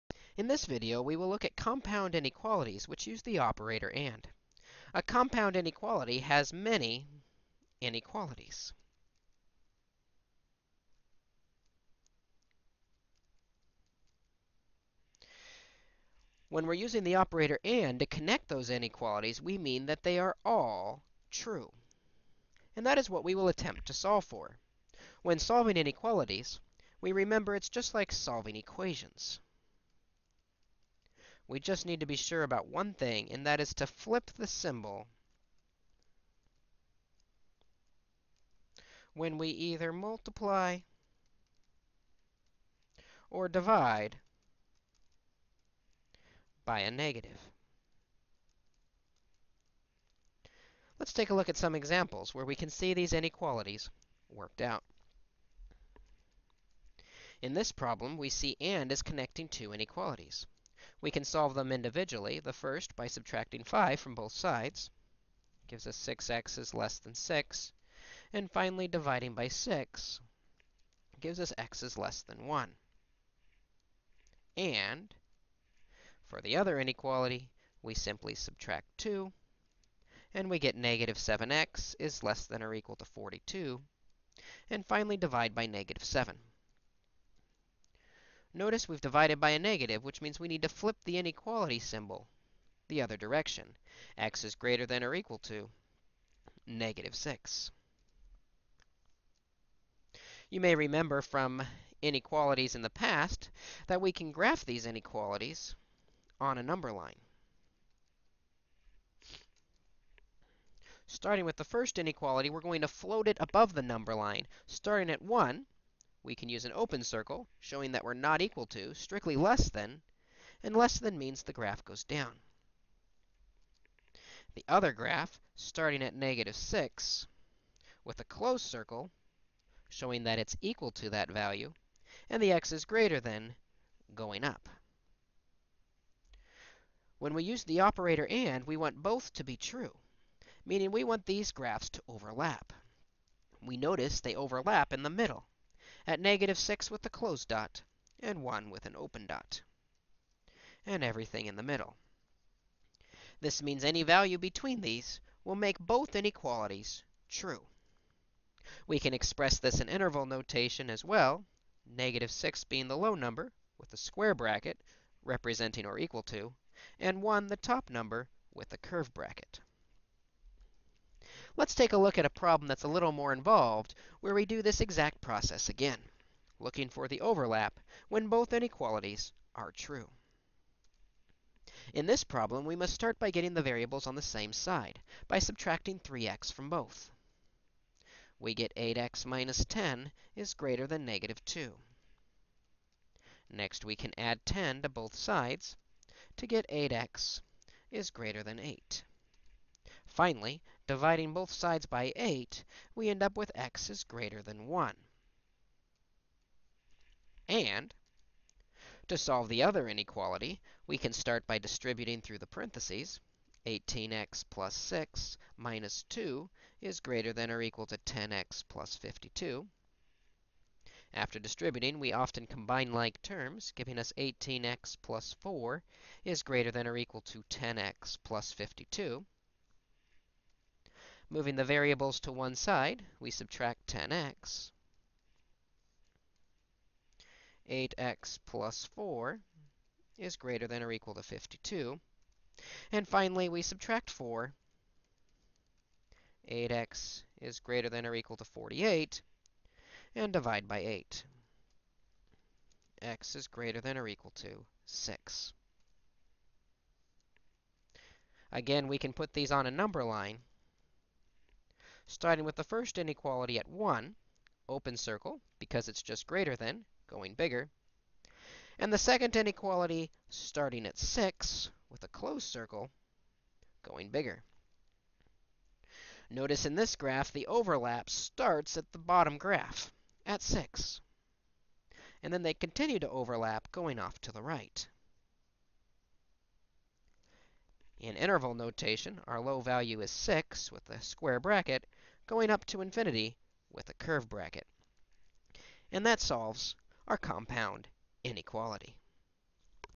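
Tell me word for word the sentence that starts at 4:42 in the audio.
And then they continue to overlap, going off to the right.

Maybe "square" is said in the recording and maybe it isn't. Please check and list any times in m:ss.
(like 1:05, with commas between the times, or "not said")
2:43, 4:51.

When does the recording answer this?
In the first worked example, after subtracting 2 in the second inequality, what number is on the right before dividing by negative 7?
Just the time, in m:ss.
1:23.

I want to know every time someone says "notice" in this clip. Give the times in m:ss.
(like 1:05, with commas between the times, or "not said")
1:28, 2:23, 4:36.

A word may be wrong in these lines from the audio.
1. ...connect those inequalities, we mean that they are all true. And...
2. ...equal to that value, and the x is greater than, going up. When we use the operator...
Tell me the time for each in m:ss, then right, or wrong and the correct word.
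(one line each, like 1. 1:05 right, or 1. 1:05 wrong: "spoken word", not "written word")
1. 0:18 right
2. 2:10 right.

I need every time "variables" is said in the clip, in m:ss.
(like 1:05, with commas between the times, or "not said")
3:03, 3:51.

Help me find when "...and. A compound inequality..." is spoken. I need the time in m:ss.
0:03.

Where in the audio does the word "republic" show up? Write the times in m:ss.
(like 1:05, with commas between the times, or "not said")
not said.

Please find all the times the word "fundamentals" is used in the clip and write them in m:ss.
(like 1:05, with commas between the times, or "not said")
not said.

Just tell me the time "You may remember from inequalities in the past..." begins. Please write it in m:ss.
1:40.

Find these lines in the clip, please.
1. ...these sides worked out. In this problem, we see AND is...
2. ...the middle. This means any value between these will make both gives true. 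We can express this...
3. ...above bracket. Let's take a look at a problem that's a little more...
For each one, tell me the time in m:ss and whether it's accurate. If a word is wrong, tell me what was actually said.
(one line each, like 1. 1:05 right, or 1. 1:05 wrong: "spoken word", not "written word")
1. 0:52 wrong: "inequalities", not "sides"
2. 2:31 wrong: "inequalities", not "gives"
3. 2:48 wrong: "curve", not "above".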